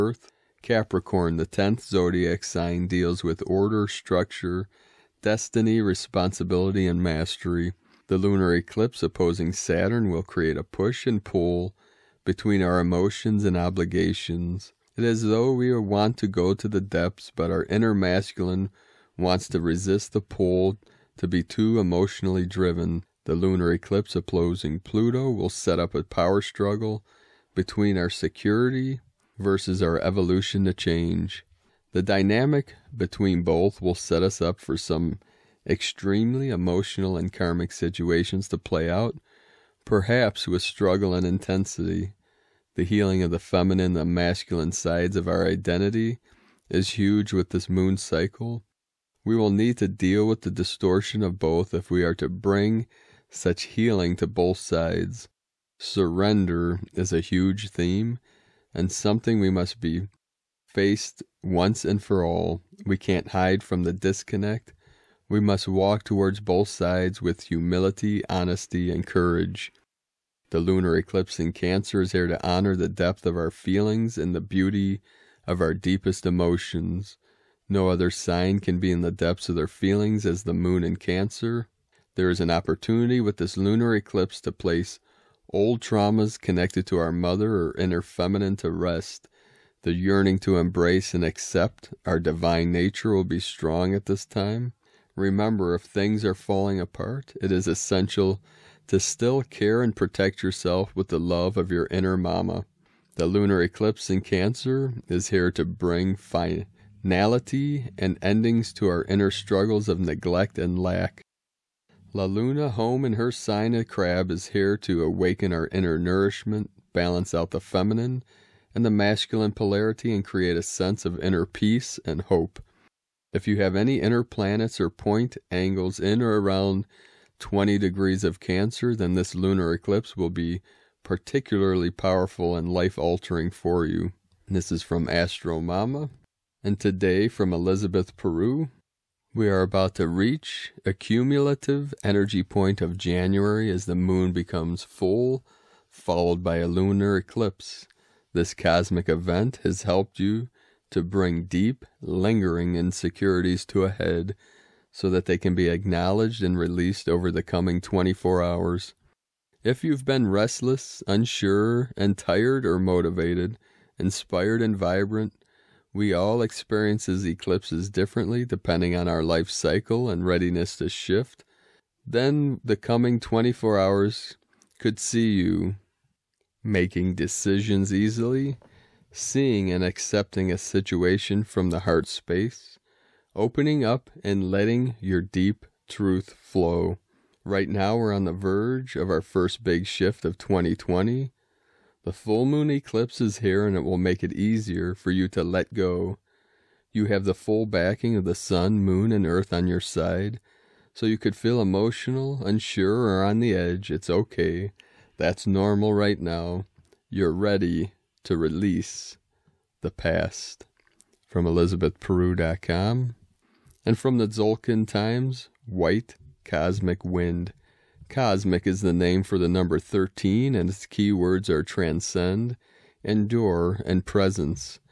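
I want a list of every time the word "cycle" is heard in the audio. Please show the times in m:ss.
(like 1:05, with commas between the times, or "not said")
0:47, 2:49.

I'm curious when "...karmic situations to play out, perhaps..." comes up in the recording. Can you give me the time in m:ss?
0:37.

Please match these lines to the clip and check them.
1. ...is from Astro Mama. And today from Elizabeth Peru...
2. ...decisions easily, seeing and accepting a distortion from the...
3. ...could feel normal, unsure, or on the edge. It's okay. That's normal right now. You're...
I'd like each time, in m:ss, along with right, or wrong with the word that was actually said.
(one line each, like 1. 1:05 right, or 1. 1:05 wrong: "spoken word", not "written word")
1. 2:14 right
2. 2:57 wrong: "situation", not "distortion"
3. 3:21 wrong: "emotional", not "normal".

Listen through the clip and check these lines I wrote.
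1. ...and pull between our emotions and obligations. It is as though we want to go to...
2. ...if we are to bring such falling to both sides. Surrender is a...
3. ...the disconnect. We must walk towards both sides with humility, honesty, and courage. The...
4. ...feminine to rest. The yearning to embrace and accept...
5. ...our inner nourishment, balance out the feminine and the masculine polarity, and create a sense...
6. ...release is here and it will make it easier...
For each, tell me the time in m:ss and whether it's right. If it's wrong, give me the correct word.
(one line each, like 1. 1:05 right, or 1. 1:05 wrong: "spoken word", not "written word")
1. 0:11 right
2. 0:51 wrong: "healing", not "falling"
3. 1:03 right
4. 1:28 right
5. 1:55 right
6. 3:12 wrong: "eclipse", not "release".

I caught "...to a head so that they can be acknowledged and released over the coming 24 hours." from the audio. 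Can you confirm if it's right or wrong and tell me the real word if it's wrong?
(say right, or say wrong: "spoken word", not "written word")
right.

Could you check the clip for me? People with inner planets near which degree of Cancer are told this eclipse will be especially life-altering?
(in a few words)
20 degrees.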